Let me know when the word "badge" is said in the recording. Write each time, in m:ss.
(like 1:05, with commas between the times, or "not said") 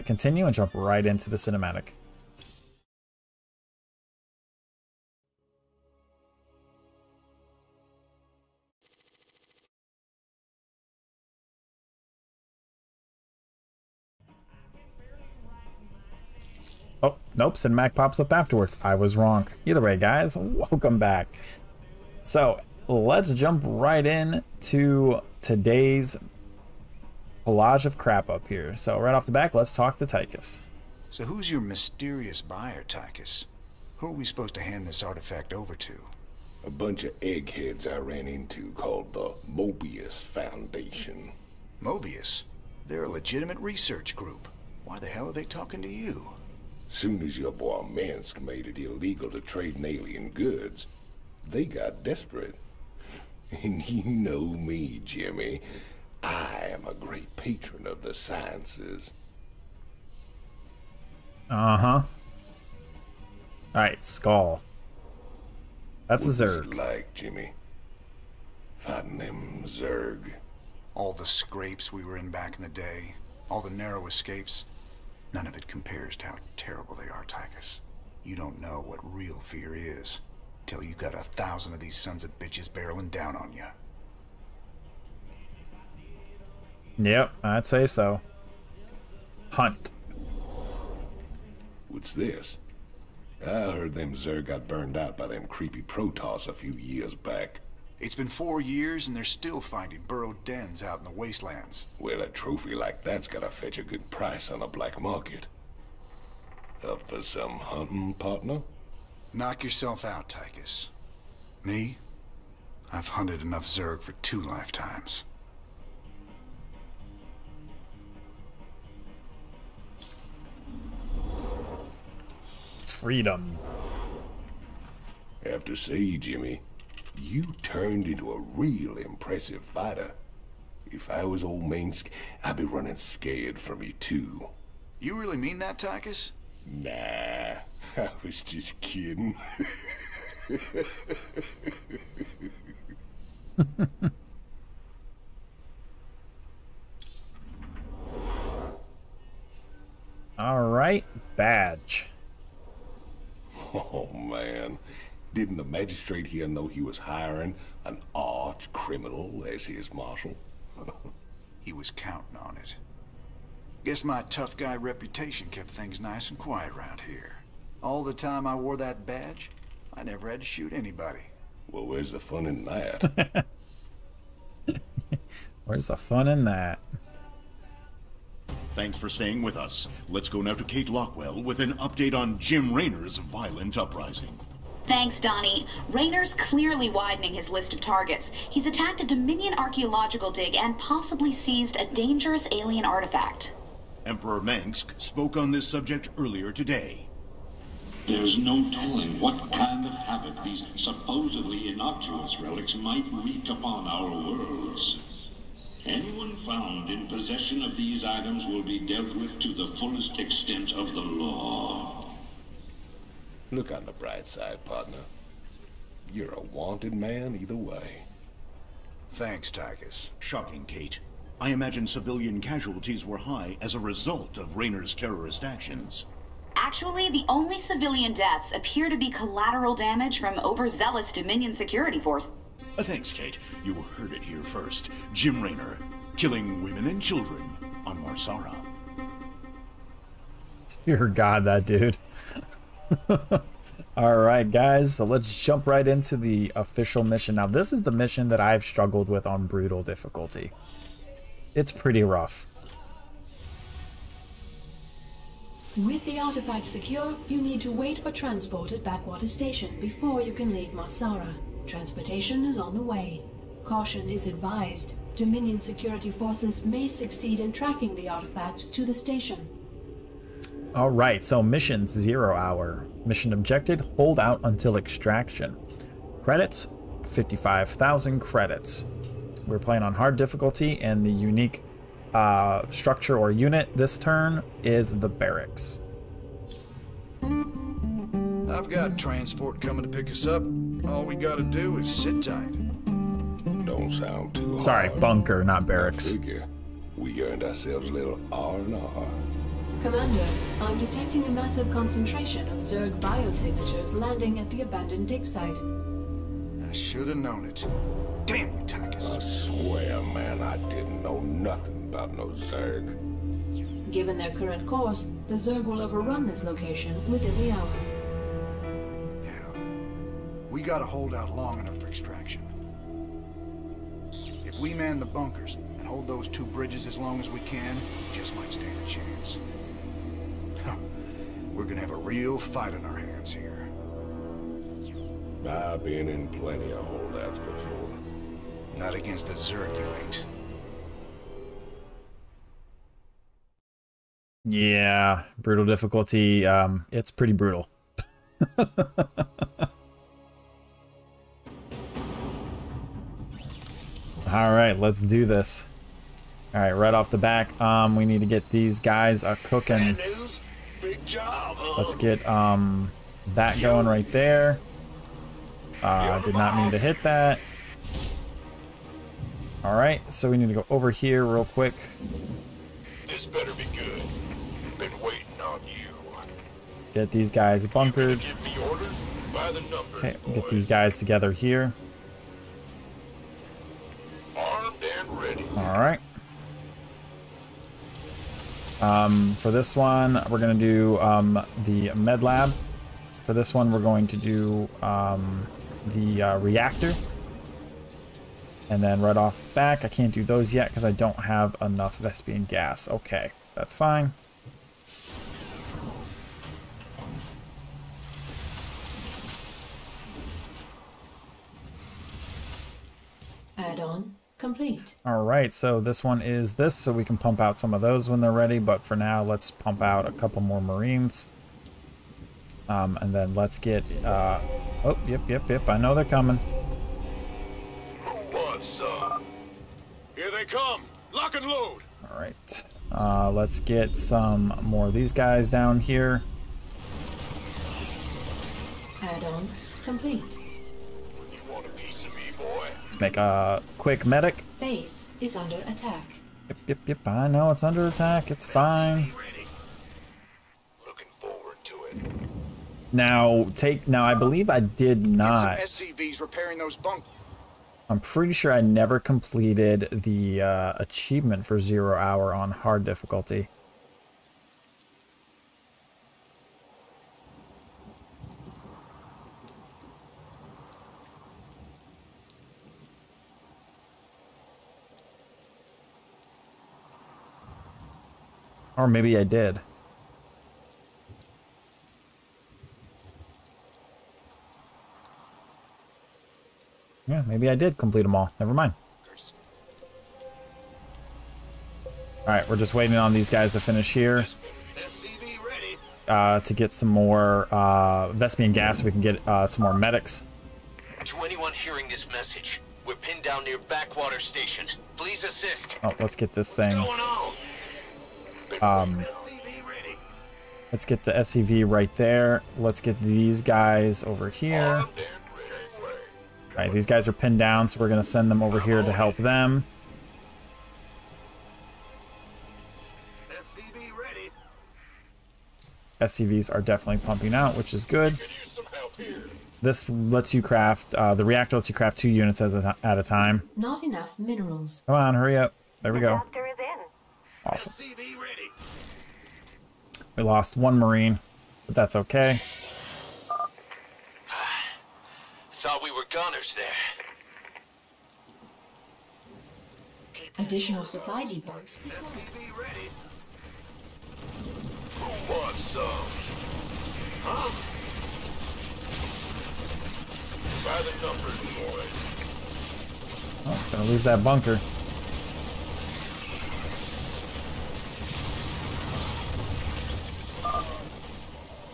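2:31, 2:49.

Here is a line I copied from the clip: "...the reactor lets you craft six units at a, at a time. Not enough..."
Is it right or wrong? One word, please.
wrong.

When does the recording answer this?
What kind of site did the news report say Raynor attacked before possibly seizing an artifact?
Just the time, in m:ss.
3:09.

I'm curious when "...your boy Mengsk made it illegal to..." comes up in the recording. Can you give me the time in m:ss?
0:47.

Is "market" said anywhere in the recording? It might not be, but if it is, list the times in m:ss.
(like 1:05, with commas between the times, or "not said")
1:45.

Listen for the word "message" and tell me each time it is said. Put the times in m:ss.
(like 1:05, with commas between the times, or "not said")
8:22.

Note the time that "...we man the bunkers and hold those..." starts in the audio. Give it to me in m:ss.
5:24.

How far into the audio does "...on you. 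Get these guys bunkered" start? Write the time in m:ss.
6:15.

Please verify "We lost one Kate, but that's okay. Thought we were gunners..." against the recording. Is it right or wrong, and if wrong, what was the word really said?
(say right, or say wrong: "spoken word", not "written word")
wrong: "Marine", not "Kate".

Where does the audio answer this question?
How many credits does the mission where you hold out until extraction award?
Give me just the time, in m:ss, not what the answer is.
4:37.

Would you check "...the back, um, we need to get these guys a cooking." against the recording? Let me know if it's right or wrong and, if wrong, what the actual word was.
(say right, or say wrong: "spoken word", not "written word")
right.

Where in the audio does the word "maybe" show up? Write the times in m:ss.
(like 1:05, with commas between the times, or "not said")
7:58, 8:07.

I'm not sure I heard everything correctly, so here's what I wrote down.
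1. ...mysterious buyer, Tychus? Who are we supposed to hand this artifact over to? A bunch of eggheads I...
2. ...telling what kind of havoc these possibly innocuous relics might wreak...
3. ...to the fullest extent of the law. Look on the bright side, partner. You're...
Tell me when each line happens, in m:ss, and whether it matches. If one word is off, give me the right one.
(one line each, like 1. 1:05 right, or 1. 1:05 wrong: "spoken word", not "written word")
1. 0:31 right
2. 3:18 wrong: "supposedly", not "possibly"
3. 3:29 right.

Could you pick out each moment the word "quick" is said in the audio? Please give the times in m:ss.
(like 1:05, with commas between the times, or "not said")
6:11, 7:23.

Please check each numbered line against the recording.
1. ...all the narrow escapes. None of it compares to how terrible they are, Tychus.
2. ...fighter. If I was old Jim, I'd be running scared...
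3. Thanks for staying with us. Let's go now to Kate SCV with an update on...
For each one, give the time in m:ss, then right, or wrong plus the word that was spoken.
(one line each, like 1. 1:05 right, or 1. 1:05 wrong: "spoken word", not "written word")
1. 1:13 right
2. 2:09 wrong: "Mengsk", not "Jim"
3. 2:58 wrong: "Lockwell", not "SCV".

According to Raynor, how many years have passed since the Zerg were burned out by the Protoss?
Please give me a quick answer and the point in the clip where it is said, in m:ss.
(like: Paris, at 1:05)
4, at 1:38.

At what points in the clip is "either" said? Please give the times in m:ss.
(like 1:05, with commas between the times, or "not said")
0:19, 3:37.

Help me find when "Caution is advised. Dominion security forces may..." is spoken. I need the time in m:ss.
4:23.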